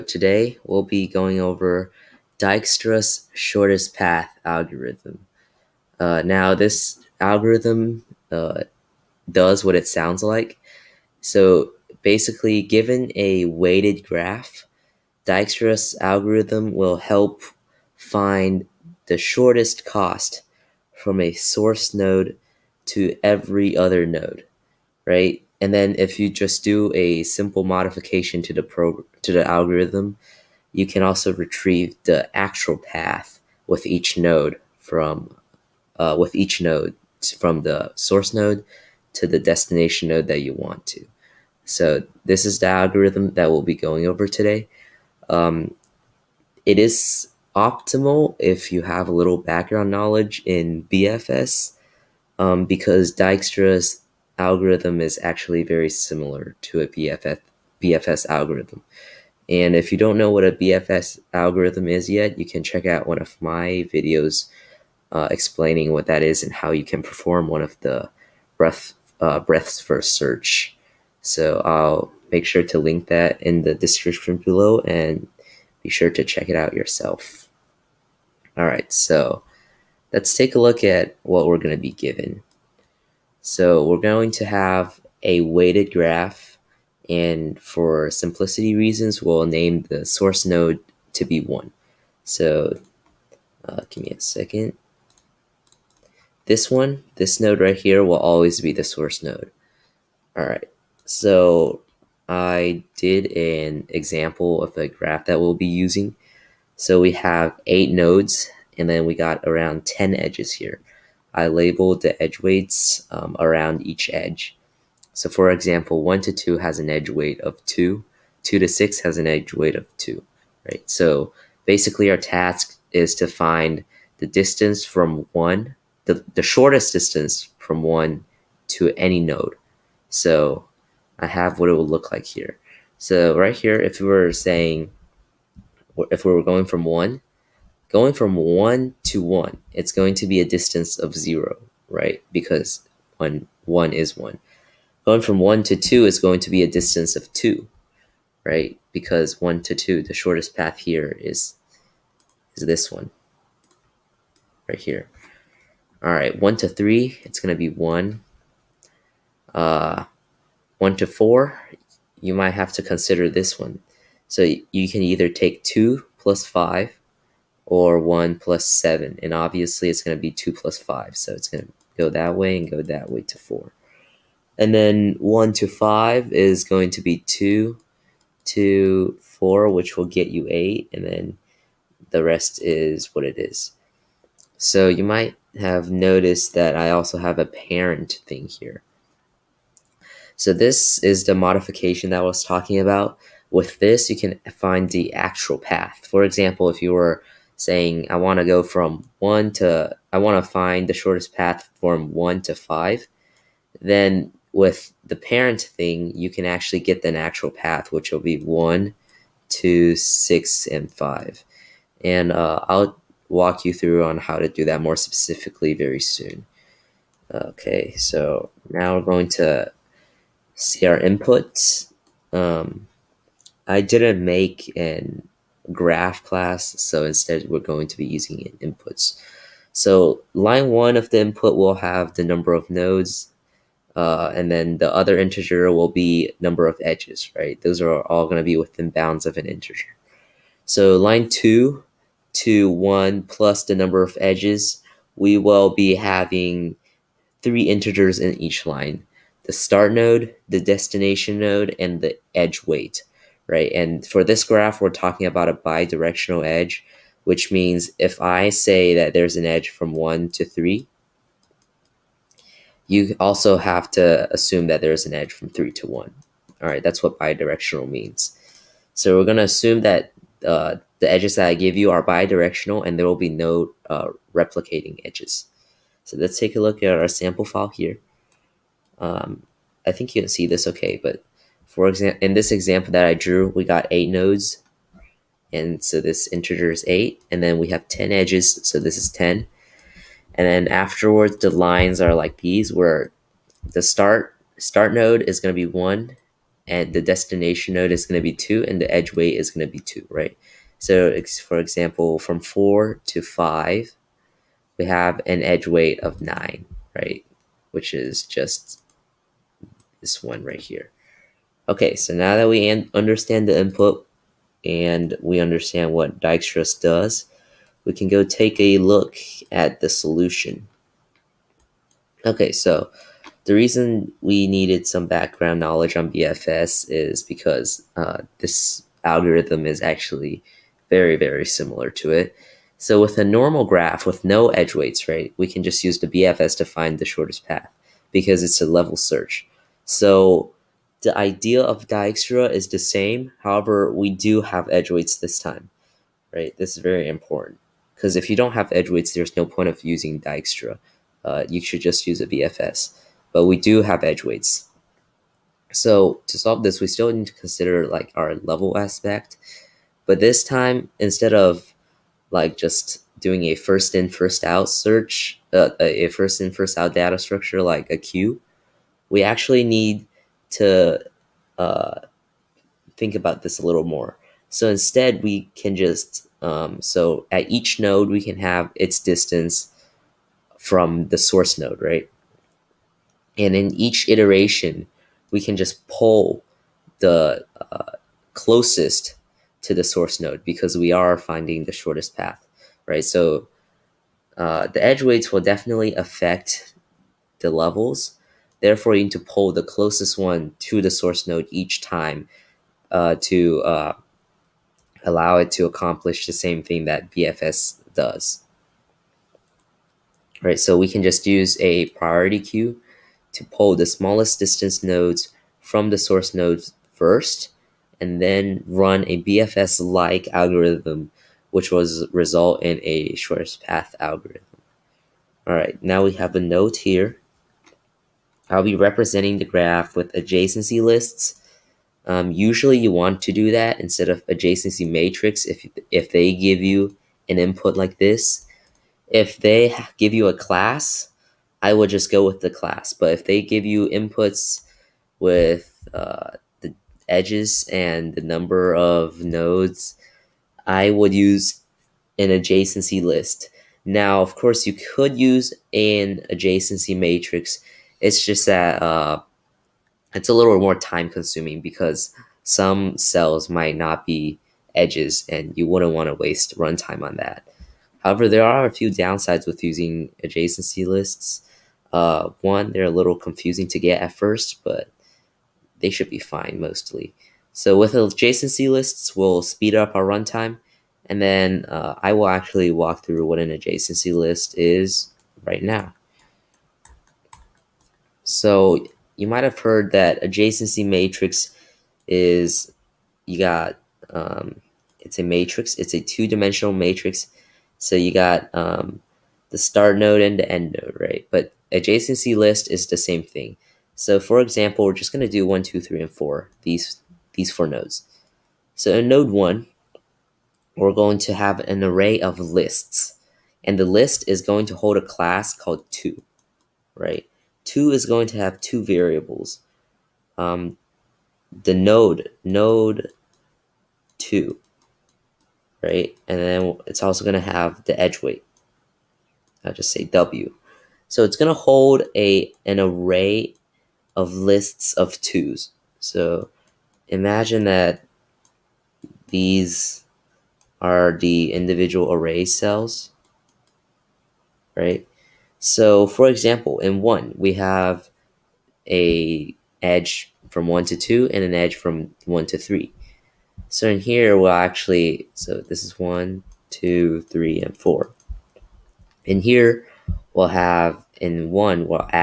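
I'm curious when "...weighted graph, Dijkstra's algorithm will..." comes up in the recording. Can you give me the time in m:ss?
0:13.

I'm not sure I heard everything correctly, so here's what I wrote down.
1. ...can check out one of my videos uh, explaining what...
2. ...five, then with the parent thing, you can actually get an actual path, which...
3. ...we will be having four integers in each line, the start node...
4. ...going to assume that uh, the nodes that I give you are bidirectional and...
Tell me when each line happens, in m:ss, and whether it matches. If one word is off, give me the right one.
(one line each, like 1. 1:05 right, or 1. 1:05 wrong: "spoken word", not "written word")
1. 1:02 right
2. 3:22 right
3. 4:05 wrong: "three", not "four"
4. 4:29 wrong: "edges", not "nodes".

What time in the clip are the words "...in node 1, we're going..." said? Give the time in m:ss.
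8:28.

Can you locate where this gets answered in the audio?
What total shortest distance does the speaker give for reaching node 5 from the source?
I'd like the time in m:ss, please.
3:00.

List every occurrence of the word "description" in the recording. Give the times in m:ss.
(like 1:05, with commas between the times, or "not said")
1:13.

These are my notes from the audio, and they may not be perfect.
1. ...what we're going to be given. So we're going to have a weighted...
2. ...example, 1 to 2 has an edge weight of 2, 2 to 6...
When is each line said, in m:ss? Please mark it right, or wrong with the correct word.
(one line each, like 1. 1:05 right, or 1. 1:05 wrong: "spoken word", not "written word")
1. 1:21 right
2. 1:55 right.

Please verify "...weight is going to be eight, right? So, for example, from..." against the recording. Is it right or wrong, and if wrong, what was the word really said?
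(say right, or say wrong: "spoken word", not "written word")
wrong: "two", not "eight".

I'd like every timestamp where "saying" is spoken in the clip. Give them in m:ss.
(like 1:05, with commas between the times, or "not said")
2:14, 3:17.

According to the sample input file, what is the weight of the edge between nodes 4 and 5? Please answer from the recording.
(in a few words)
9.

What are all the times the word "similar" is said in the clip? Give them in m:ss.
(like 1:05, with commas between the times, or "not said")
0:55, 5:31.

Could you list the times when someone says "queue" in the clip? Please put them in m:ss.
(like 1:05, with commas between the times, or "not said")
6:07, 6:52.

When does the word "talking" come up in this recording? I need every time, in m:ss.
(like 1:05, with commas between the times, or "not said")
3:12, 4:14.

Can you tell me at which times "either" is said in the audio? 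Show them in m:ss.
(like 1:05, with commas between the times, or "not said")
2:45.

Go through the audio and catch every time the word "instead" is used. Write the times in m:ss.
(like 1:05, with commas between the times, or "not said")
3:47, 6:00, 6:14, 7:13.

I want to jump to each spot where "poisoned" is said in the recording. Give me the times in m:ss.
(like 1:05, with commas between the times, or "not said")
not said.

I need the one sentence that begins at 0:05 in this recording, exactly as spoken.
Uh, now, this algorithm uh, does what it sounds like.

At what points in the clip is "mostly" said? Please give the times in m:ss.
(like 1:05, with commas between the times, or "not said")
7:56.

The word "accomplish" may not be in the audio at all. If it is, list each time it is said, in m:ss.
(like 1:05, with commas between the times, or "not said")
6:45.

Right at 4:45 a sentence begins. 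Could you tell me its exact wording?
And so this integer is eight.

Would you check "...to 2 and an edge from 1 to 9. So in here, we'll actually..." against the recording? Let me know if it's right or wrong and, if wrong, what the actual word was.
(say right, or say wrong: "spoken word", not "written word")
wrong: "3", not "9".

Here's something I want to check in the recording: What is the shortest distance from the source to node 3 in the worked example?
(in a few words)
1.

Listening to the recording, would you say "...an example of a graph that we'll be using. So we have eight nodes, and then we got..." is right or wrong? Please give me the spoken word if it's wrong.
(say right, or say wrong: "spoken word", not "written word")
right.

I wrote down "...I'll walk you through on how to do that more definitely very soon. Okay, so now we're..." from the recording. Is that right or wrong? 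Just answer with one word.
wrong.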